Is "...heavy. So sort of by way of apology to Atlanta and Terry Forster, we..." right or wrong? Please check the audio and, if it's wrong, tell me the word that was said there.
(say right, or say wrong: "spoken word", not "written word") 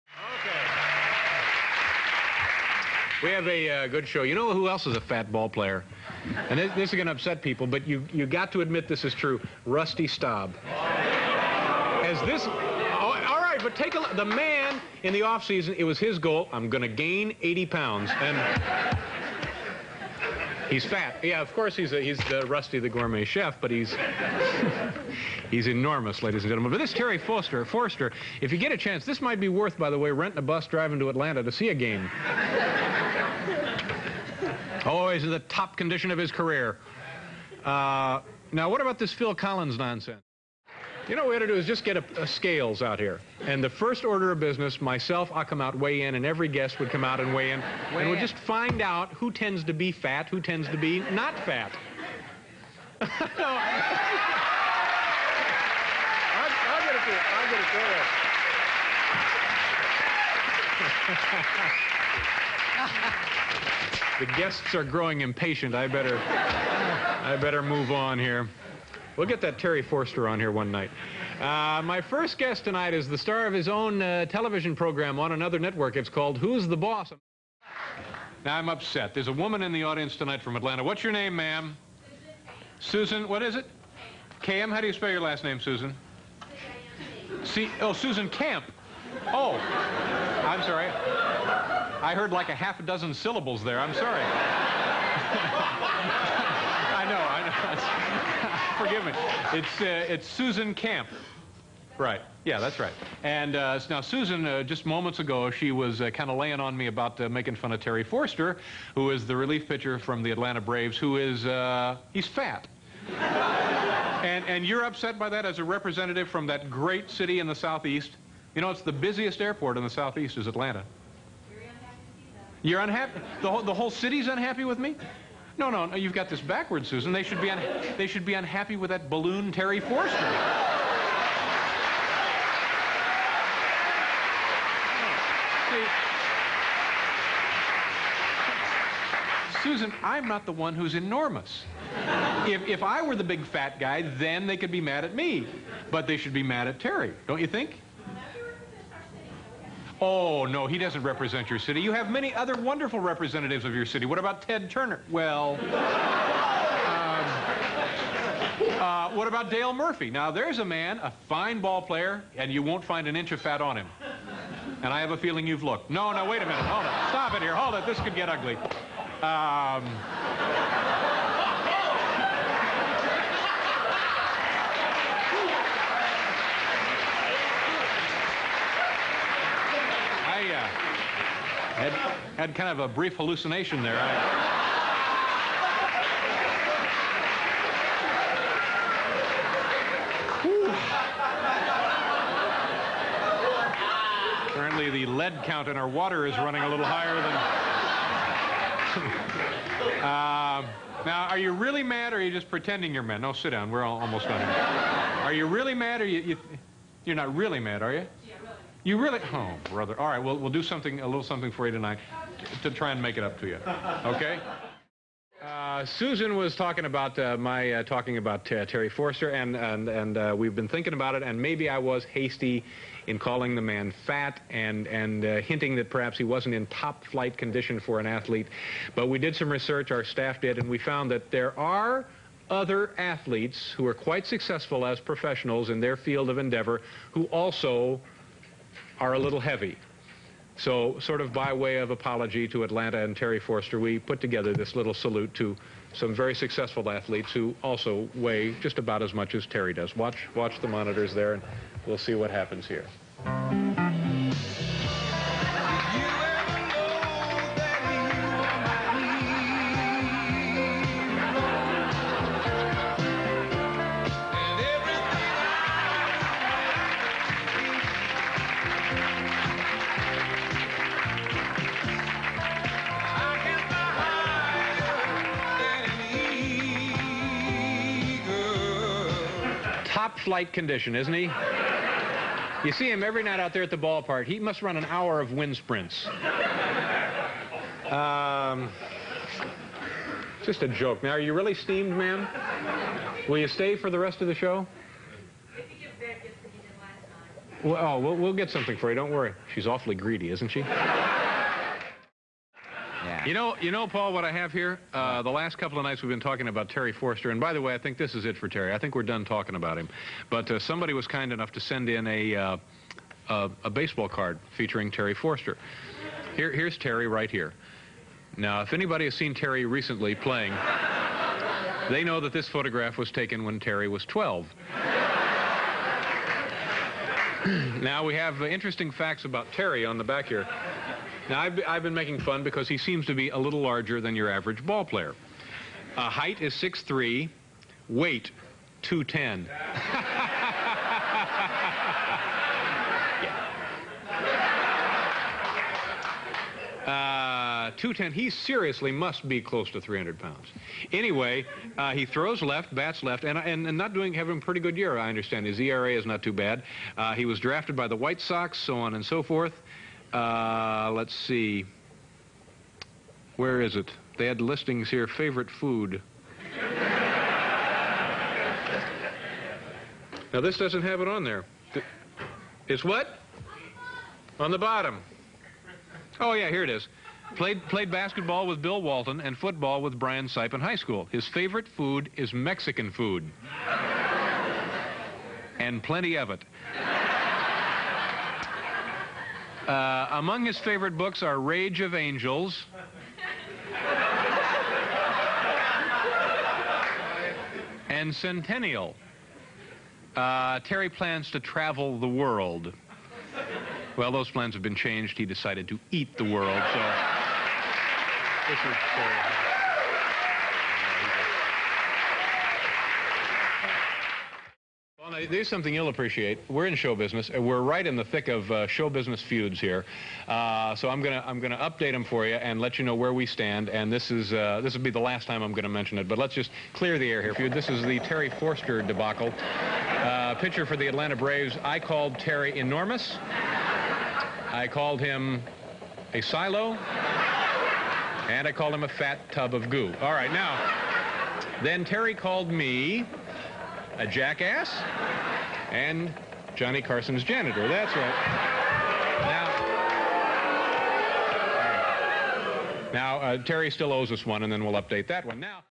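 right.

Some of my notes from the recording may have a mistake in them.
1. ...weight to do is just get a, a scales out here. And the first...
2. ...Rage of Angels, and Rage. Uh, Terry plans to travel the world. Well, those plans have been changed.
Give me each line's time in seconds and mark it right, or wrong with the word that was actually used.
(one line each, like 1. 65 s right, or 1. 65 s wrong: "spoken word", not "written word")
1. 41 s wrong: "ought", not "weight"
2. 391 s wrong: "Centennial", not "Rage".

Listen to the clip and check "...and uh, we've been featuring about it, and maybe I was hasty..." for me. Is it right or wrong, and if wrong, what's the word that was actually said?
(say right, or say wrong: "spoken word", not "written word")
wrong: "thinking", not "featuring".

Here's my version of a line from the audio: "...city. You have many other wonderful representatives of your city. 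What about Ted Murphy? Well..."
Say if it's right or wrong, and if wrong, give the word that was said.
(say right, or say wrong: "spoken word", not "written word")
wrong: "Turner", not "Murphy".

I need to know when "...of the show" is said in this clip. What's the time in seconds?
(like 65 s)
294 s.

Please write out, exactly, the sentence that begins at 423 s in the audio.
And this is uh, this will be the last time I'm gonna mention it.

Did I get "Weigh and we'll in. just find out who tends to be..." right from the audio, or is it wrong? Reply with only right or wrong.
right.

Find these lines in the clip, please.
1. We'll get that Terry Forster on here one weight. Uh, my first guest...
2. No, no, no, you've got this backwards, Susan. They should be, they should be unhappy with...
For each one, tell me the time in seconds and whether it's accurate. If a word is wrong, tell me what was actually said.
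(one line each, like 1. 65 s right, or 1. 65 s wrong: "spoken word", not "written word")
1. 69 s wrong: "night", not "weight"
2. 125 s right.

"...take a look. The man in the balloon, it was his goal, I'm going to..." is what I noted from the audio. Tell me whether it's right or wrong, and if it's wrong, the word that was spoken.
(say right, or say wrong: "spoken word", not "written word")
wrong: "offseason", not "balloon".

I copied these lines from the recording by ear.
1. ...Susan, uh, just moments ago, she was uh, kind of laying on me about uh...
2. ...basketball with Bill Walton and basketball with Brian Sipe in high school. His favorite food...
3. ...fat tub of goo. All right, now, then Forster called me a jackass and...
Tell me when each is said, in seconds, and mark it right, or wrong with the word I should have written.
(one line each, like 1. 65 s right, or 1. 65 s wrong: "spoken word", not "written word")
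1. 104 s right
2. 377 s wrong: "football", not "basketball"
3. 438 s wrong: "Terry", not "Forster".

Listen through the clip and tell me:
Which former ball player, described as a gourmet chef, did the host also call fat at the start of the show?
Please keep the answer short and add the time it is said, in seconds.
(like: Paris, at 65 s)
Rusty Staub, at 9 s.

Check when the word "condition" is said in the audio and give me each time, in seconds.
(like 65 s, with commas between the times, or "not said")
35 s, 227 s, 280 s.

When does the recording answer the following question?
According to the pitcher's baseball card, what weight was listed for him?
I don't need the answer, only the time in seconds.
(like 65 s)
337 s.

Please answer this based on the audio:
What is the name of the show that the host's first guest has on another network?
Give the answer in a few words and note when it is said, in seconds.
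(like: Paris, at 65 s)
Who's the Boss?, at 76 s.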